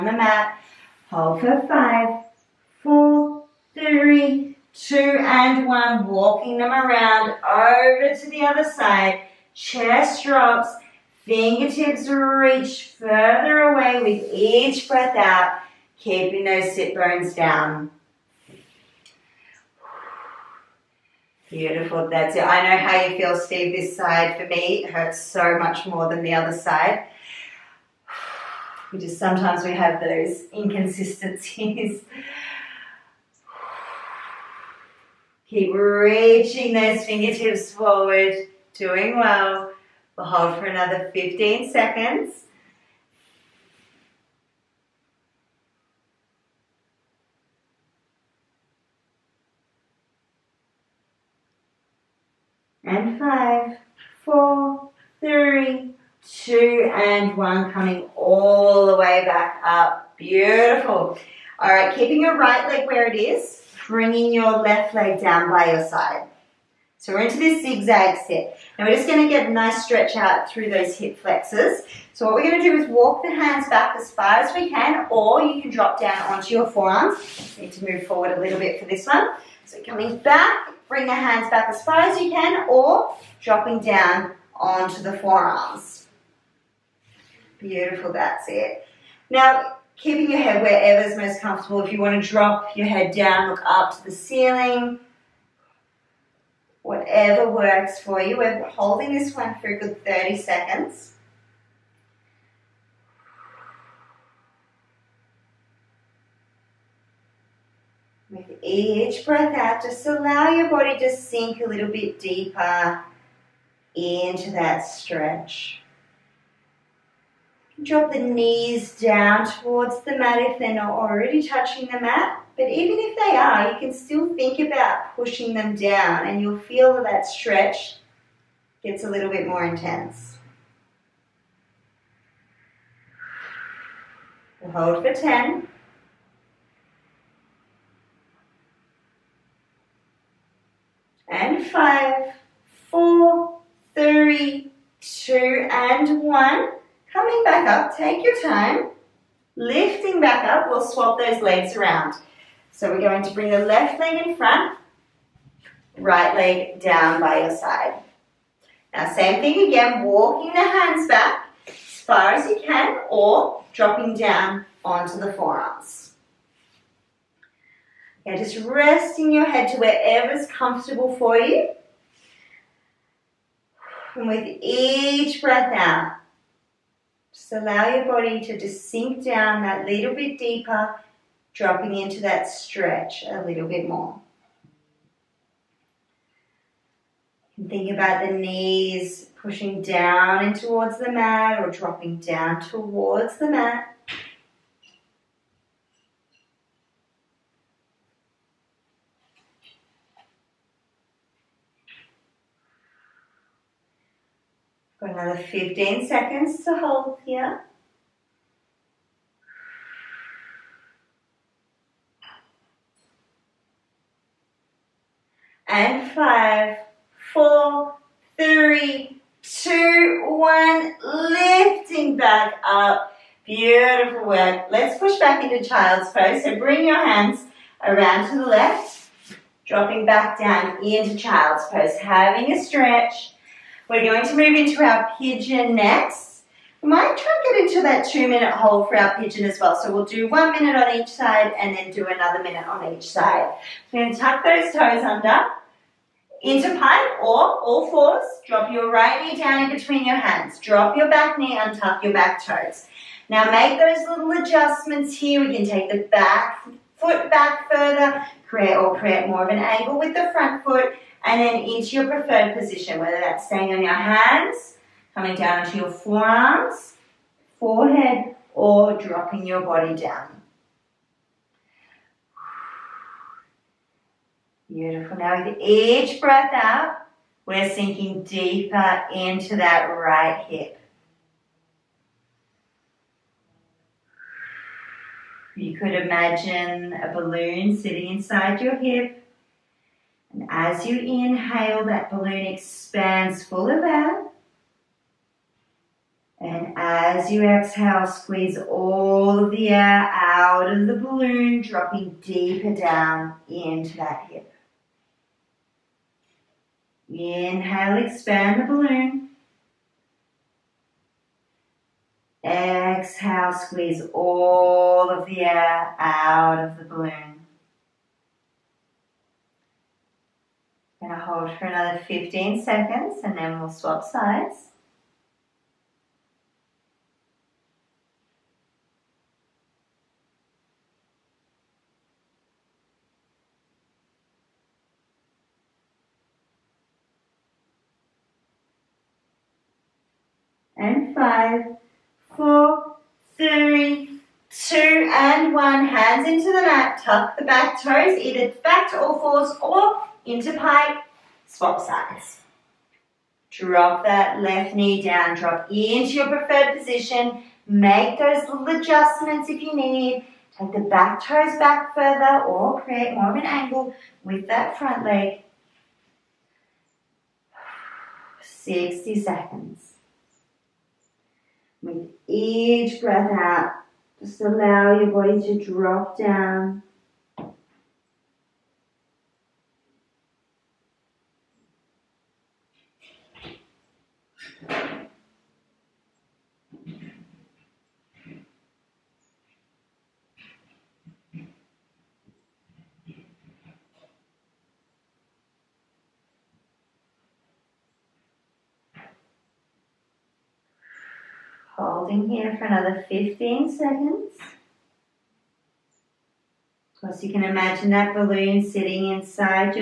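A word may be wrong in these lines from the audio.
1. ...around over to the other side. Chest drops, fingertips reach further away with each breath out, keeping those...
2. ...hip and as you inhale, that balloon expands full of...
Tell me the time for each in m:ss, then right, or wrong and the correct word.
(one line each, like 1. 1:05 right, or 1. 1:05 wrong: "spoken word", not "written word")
1. 0:06 right
2. 4:48 right.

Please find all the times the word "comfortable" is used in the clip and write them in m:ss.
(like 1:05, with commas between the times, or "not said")
1:31, 2:50.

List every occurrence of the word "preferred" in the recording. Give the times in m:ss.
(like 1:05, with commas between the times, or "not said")
4:22, 5:56.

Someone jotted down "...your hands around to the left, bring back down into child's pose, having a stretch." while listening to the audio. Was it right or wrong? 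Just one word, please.
wrong.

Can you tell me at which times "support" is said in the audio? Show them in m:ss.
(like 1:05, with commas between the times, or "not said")
not said.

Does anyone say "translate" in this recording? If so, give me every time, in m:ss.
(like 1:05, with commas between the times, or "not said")
not said.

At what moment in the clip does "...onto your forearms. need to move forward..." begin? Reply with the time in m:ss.
1:16.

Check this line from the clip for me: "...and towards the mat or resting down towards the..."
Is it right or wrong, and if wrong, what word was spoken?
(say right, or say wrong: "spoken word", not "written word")
wrong: "dropping", not "resting".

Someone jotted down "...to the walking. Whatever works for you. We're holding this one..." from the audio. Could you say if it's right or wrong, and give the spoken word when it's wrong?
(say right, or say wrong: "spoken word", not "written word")
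wrong: "ceiling", not "walking".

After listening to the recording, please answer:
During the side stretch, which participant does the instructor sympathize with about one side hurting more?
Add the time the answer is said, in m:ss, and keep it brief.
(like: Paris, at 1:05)
Steve, at 0:23.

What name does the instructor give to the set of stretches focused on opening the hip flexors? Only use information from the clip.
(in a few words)
zigzag.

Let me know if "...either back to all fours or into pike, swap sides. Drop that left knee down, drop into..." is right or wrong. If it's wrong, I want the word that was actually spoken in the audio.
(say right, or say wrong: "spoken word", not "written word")
right.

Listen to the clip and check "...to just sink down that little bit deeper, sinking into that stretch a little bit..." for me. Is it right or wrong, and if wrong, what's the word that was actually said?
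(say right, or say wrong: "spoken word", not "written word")
wrong: "dropping", not "sinking".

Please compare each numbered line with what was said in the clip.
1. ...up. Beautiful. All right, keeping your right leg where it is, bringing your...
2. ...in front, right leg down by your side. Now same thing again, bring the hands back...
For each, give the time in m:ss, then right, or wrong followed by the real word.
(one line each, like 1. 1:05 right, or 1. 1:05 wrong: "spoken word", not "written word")
1. 0:59 right
2. 2:34 wrong: "walking", not "bring".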